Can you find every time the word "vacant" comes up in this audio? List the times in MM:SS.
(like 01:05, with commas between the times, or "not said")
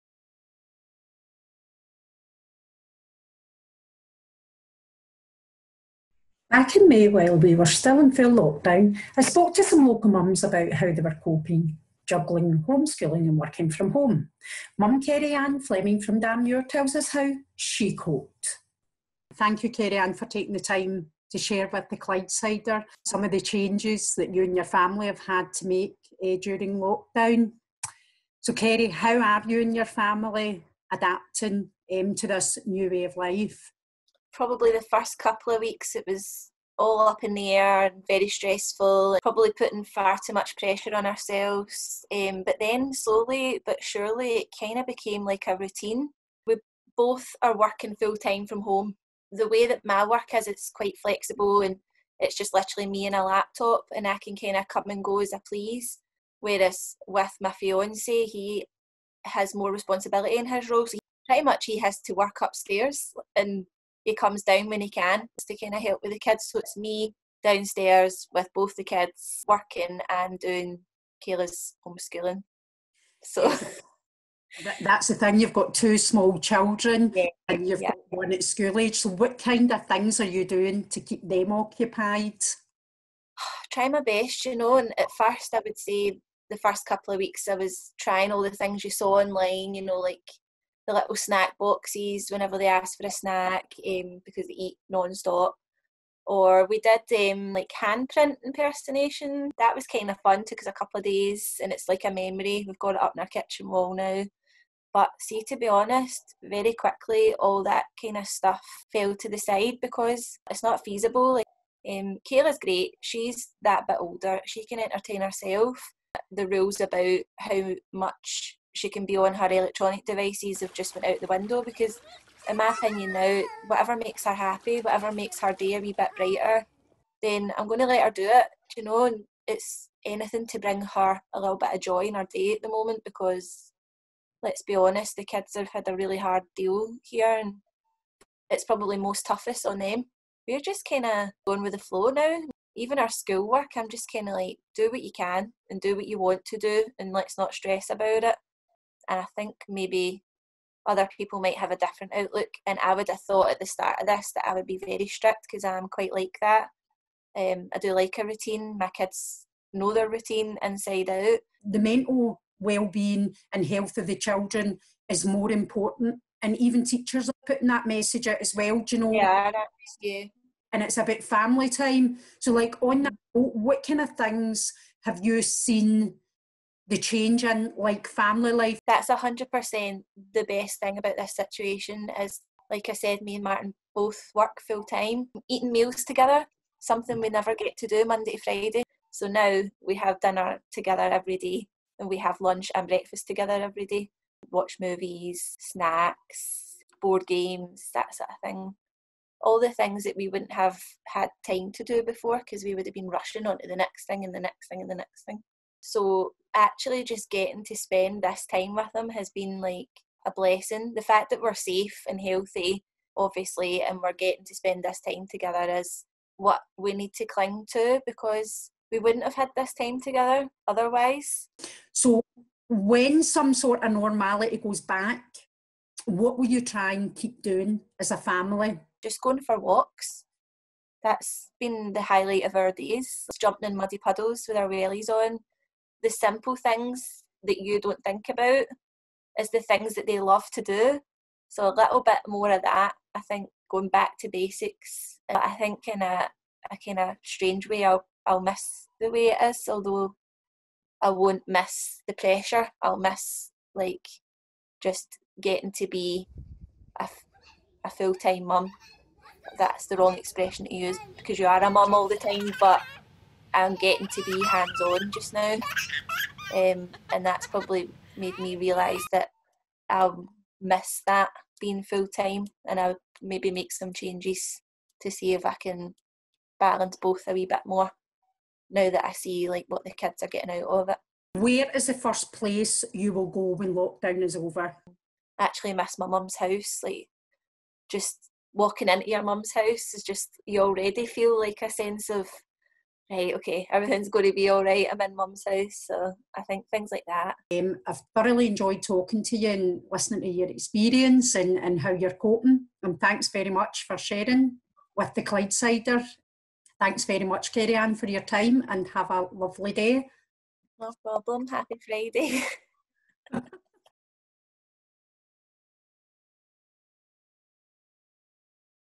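not said.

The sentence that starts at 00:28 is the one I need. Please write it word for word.
So, Kerry, how are you and your family adapting um, to this new way of life?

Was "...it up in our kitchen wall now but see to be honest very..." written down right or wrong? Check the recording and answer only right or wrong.
right.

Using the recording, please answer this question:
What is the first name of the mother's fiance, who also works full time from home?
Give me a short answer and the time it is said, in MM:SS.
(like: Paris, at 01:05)
Martin, at 03:03.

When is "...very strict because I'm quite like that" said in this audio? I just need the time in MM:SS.
02:34.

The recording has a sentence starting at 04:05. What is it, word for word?
I think in a, a kind of strange way, I'll, I'll miss the way it is, although I won't miss the pressure.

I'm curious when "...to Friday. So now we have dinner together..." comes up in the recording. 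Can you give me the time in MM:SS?
03:08.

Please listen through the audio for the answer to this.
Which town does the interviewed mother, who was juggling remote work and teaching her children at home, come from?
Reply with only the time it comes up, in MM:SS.
00:16.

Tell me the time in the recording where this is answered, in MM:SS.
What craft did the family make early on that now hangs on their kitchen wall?
01:37.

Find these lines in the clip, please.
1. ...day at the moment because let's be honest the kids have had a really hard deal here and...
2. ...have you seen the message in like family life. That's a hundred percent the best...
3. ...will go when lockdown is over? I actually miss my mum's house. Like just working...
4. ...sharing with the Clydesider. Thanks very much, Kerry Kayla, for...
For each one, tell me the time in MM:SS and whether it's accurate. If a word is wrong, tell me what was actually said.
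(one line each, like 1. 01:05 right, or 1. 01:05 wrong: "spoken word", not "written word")
1. 02:12 right
2. 02:55 wrong: "change", not "message"
3. 04:43 wrong: "walking", not "working"
4. 05:03 wrong: "Anne", not "Kayla".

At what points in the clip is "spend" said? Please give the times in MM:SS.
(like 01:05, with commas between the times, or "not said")
03:27, 03:34.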